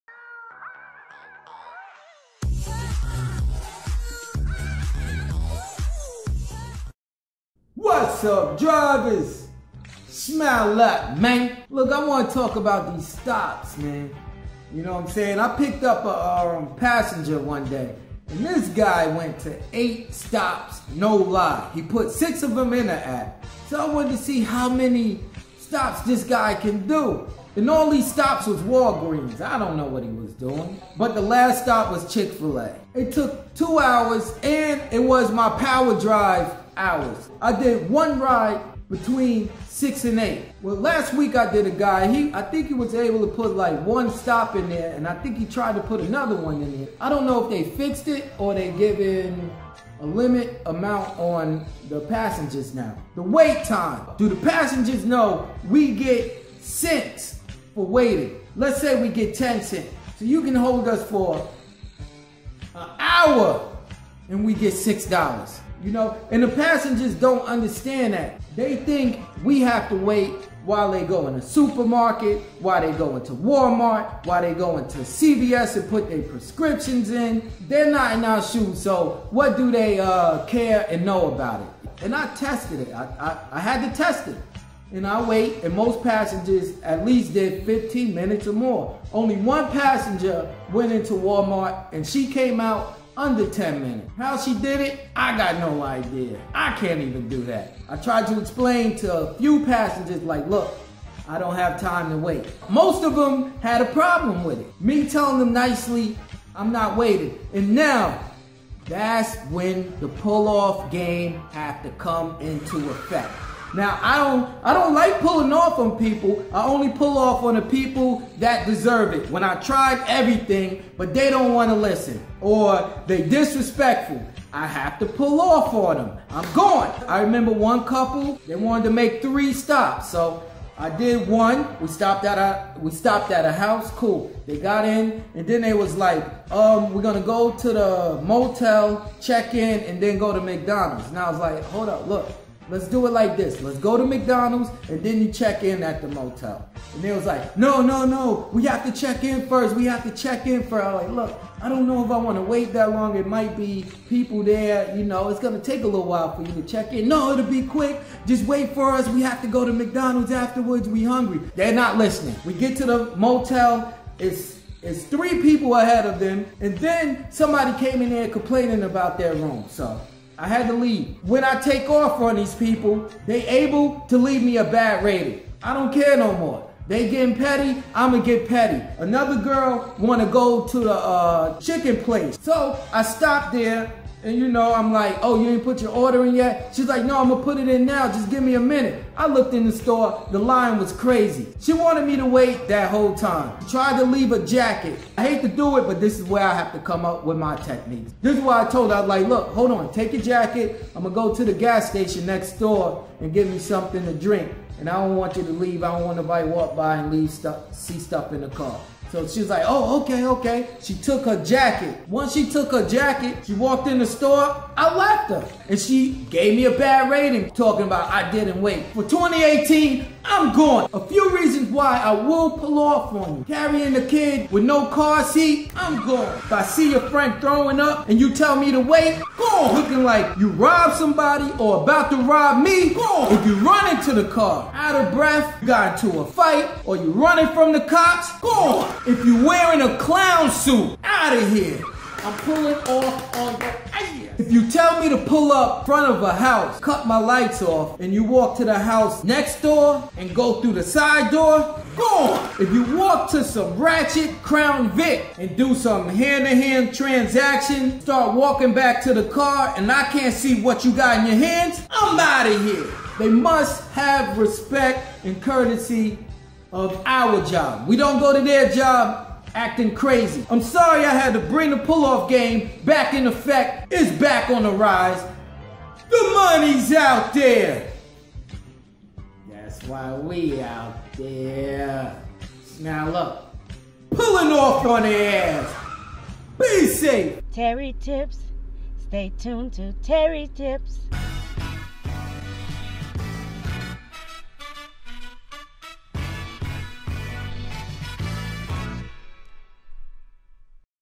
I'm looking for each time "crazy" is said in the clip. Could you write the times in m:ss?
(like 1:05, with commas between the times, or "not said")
3:10, 4:29.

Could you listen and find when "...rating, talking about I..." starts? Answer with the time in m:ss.
3:37.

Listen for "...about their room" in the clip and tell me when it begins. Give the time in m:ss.
2:48.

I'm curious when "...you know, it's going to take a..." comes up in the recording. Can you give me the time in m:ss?
2:34.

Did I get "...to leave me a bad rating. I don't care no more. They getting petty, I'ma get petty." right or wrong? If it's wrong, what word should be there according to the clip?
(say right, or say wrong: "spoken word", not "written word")
right.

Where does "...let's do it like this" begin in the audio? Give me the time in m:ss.
2:22.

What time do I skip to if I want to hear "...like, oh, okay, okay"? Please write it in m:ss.
3:29.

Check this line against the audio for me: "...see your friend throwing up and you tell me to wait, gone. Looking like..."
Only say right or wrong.
right.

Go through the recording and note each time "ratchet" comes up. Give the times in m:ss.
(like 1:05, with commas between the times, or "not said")
4:13.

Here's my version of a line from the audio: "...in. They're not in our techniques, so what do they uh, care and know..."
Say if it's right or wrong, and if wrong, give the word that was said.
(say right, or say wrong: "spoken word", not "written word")
wrong: "shoes", not "techniques".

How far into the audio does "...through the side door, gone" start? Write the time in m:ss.
4:10.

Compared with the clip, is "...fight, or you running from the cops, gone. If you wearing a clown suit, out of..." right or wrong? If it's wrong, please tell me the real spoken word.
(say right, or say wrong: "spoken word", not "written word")
right.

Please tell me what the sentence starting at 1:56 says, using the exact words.
I only pull off on the people that deserve it.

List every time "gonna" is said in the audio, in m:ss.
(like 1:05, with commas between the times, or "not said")
2:17, 3:07, 3:21.